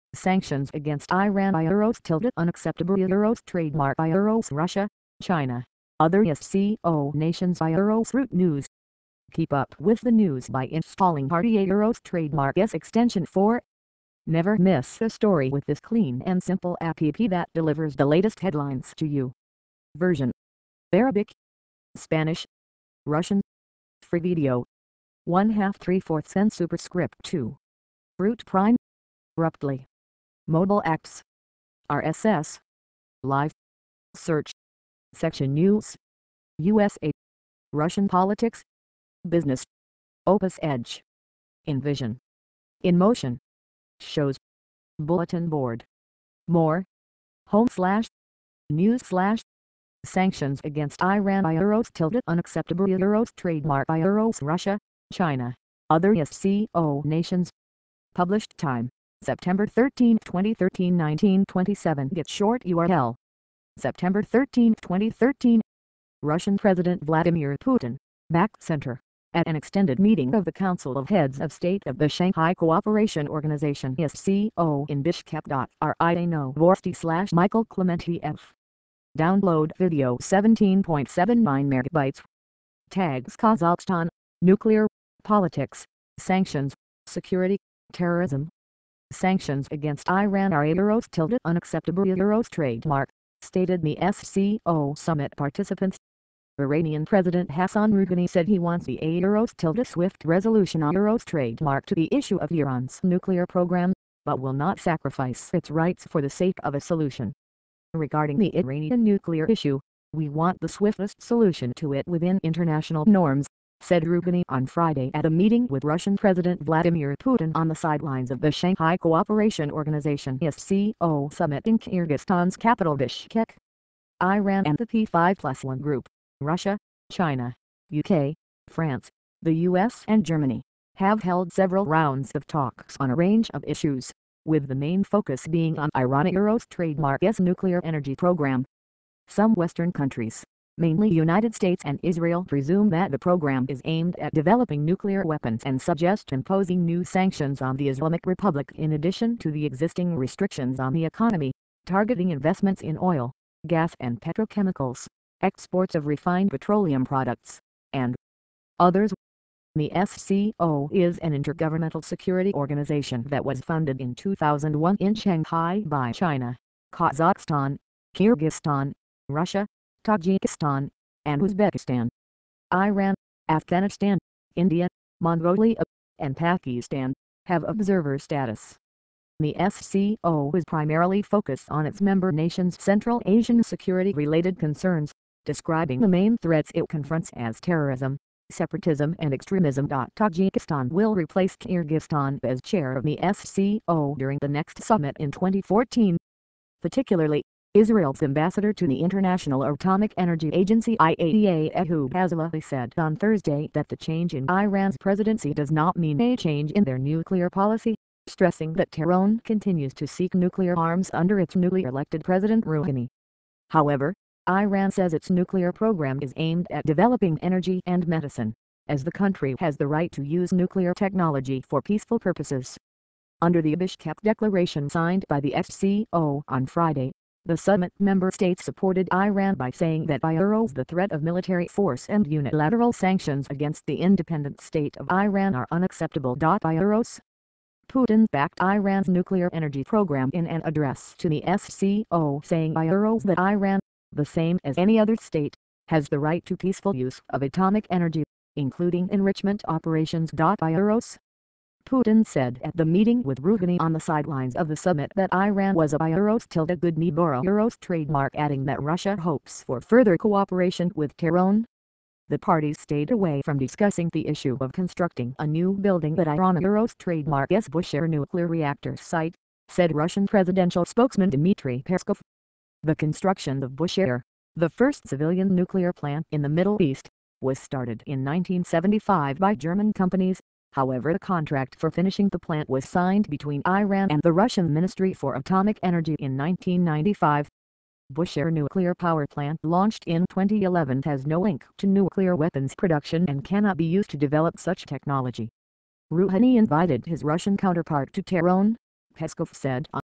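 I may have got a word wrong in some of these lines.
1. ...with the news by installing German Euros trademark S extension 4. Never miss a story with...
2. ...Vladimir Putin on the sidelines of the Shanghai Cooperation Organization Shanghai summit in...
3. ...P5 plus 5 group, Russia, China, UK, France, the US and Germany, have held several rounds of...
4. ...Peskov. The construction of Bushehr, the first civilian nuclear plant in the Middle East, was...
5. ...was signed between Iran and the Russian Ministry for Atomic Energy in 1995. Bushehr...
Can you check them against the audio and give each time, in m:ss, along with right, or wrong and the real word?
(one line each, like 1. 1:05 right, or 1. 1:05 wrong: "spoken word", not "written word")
1. 0:09 wrong: "Party", not "German"
2. 1:56 wrong: "SCO", not "Shanghai"
3. 2:04 wrong: "1", not "5"
4. 4:31 right
5. 4:42 right.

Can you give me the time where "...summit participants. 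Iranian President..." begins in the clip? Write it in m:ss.
1:34.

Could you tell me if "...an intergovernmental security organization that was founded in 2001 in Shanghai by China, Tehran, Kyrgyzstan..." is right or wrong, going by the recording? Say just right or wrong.
wrong.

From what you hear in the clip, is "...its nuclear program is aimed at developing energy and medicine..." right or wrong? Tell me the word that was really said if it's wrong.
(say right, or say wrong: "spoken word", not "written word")
right.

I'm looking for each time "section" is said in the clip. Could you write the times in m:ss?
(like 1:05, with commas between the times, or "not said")
0:35.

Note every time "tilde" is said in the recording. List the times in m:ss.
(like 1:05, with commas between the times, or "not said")
0:02, 0:51, 1:31, 1:39, 4:16.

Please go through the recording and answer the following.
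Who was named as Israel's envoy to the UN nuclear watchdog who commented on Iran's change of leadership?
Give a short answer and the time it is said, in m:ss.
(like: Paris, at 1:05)
Ehud Azoulay, at 3:21.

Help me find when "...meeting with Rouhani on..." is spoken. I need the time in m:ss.
4:12.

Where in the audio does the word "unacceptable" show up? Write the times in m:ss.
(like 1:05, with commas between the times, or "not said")
0:02, 0:52, 1:31, 3:55.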